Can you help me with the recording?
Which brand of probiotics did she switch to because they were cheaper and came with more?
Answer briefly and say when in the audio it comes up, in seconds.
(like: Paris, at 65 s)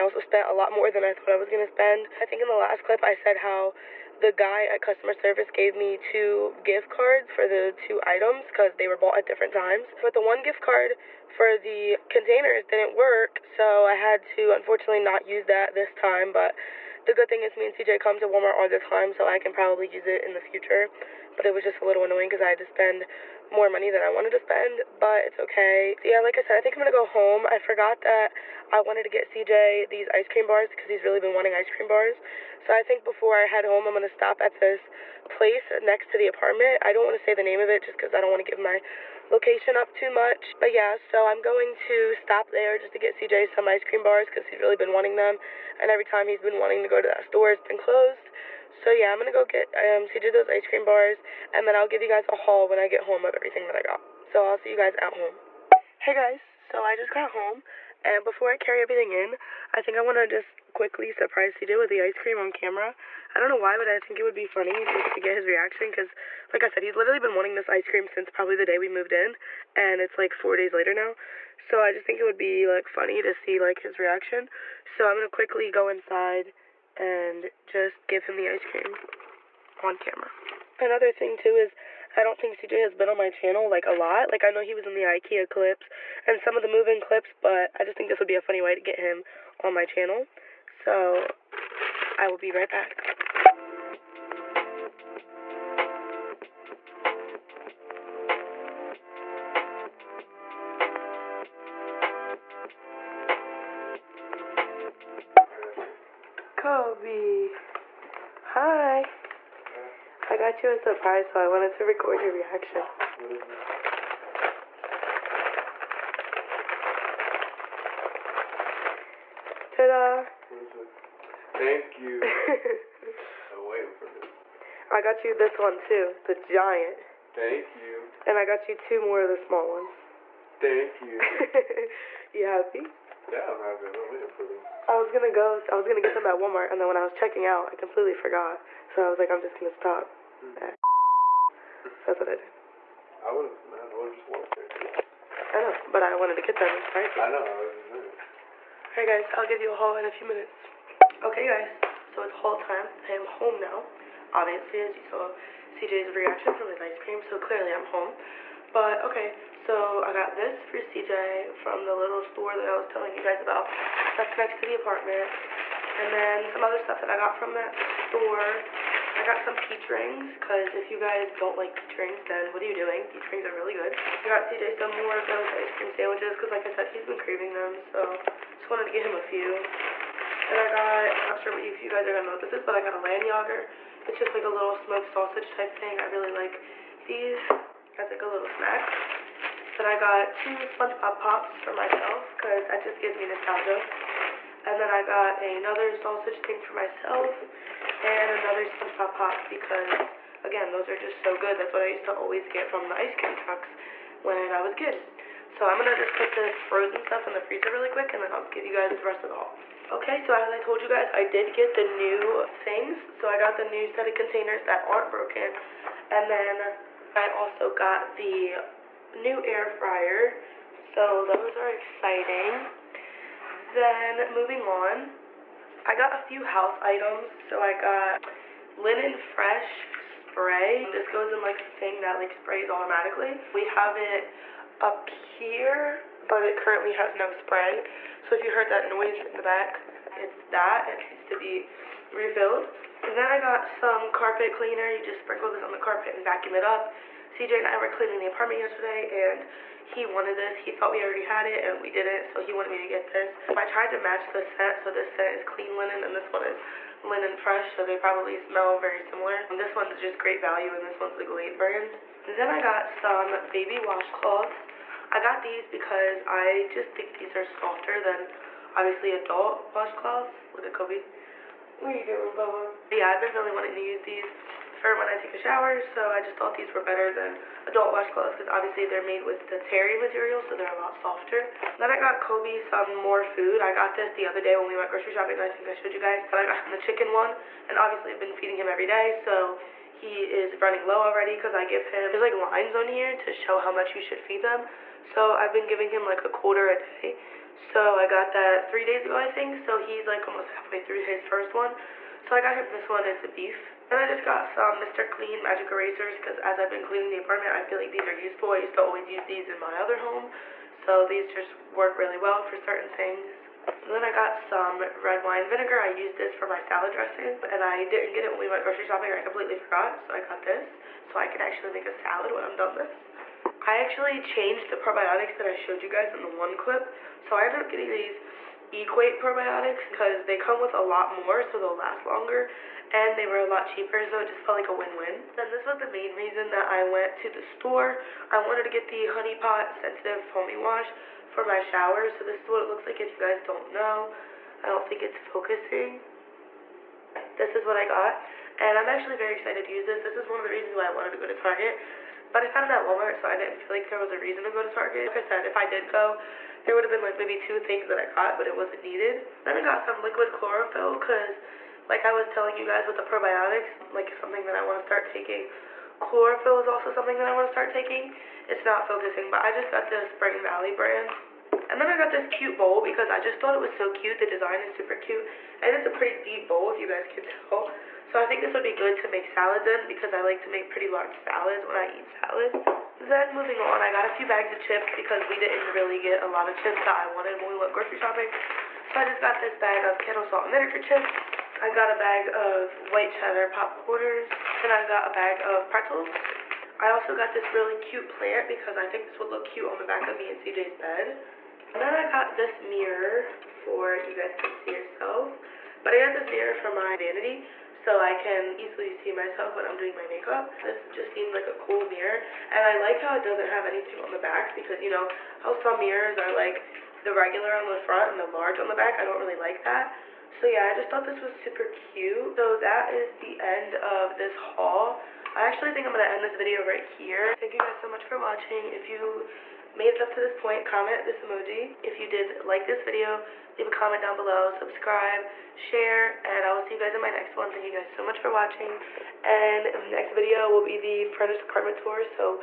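Equate, at 328 s.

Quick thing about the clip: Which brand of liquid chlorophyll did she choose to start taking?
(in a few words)
Spring Valley.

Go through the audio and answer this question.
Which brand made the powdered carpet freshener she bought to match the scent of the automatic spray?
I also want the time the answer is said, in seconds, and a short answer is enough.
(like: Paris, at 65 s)
Great Value, at 260 s.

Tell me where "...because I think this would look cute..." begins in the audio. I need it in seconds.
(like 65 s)
398 s.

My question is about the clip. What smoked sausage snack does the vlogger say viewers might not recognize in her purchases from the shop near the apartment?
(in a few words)
landjaeger.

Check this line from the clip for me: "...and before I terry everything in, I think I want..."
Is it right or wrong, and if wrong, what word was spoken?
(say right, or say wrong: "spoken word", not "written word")
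wrong: "carry", not "terry".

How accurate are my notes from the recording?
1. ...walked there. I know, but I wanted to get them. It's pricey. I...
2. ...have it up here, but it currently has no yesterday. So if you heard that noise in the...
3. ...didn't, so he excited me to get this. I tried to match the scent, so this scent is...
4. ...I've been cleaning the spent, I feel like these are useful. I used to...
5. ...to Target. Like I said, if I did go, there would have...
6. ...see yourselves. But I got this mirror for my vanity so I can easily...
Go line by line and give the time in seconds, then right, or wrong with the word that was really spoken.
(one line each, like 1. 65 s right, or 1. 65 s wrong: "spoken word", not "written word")
1. 144 s right
2. 233 s wrong: "spray", not "yesterday"
3. 251 s wrong: "wanted", not "excited"
4. 306 s wrong: "apartment", not "spent"
5. 354 s right
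6. 404 s right.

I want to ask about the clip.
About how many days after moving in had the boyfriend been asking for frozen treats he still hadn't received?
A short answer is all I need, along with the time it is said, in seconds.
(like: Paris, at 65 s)
4, at 70 s.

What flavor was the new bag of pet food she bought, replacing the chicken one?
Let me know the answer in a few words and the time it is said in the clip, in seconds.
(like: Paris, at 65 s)
beef, at 303 s.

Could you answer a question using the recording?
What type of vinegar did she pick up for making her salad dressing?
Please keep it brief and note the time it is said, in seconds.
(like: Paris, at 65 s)
red wine vinegar, at 315 s.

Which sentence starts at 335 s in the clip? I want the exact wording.
Then this was the main reason that I went to the store.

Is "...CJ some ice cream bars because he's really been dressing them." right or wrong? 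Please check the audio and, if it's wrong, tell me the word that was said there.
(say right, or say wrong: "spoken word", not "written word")
wrong: "wanting", not "dressing".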